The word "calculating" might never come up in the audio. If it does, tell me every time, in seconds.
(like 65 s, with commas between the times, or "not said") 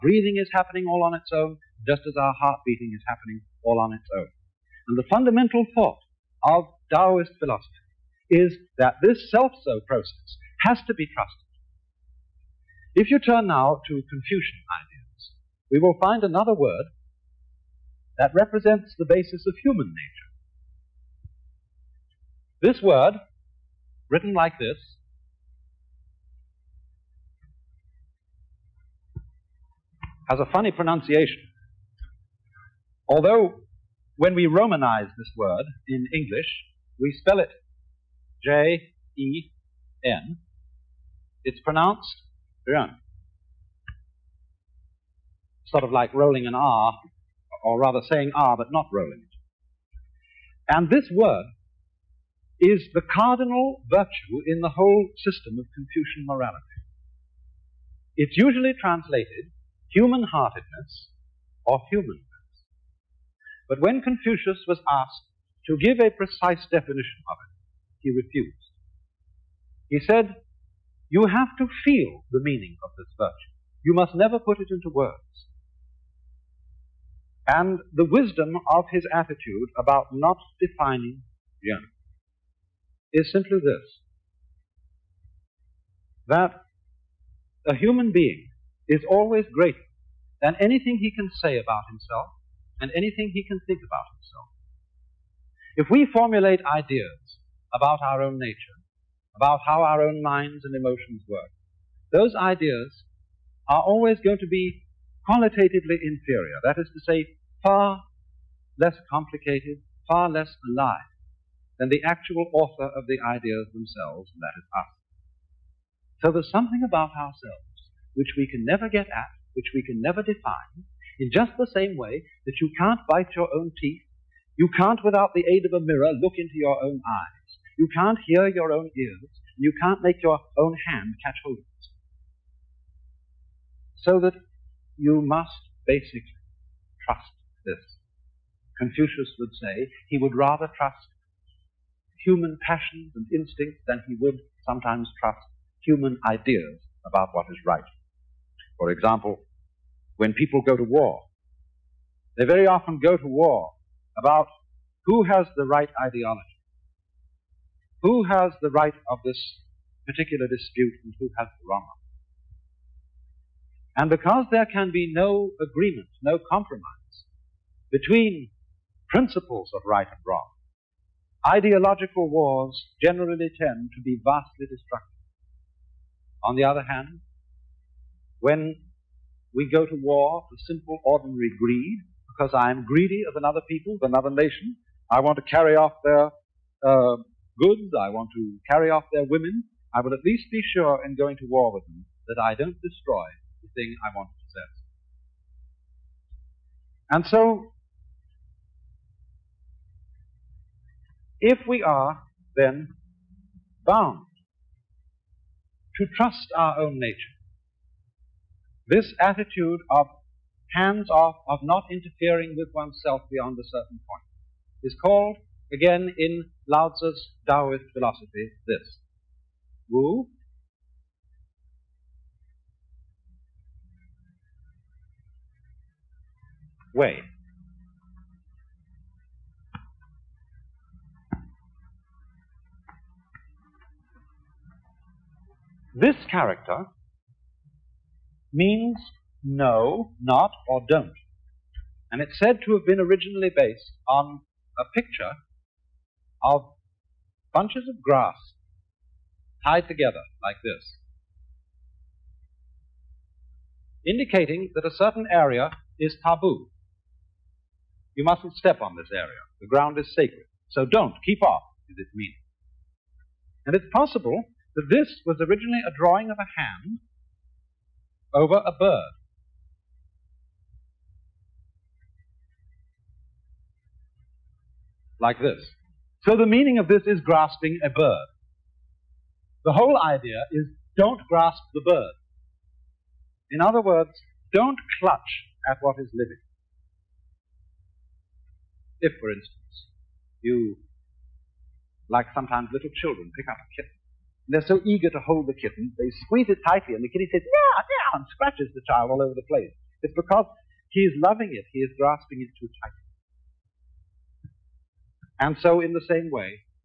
not said.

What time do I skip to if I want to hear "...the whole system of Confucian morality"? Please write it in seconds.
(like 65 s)
54 s.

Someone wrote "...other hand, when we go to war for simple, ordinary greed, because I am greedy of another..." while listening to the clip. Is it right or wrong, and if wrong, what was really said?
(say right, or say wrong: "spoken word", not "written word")
right.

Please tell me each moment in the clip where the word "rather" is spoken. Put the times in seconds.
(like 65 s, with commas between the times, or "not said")
47 s, 140 s.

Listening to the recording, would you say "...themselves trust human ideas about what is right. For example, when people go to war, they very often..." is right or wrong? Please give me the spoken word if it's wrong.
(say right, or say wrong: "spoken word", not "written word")
wrong: "sometimes", not "themselves".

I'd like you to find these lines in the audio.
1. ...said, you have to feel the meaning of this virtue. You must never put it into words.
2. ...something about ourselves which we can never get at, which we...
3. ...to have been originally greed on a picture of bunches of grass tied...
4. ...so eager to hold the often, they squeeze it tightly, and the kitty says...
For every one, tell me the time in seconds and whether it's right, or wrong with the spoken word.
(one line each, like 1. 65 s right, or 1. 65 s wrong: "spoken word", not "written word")
1. 69 s right
2. 116 s right
3. 242 s wrong: "based", not "greed"
4. 294 s wrong: "kitten", not "often".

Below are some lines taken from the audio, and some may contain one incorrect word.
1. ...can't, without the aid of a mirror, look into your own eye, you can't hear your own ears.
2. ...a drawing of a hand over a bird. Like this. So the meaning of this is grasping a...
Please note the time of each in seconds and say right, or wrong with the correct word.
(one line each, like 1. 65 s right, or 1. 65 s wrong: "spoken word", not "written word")
1. 124 s right
2. 265 s right.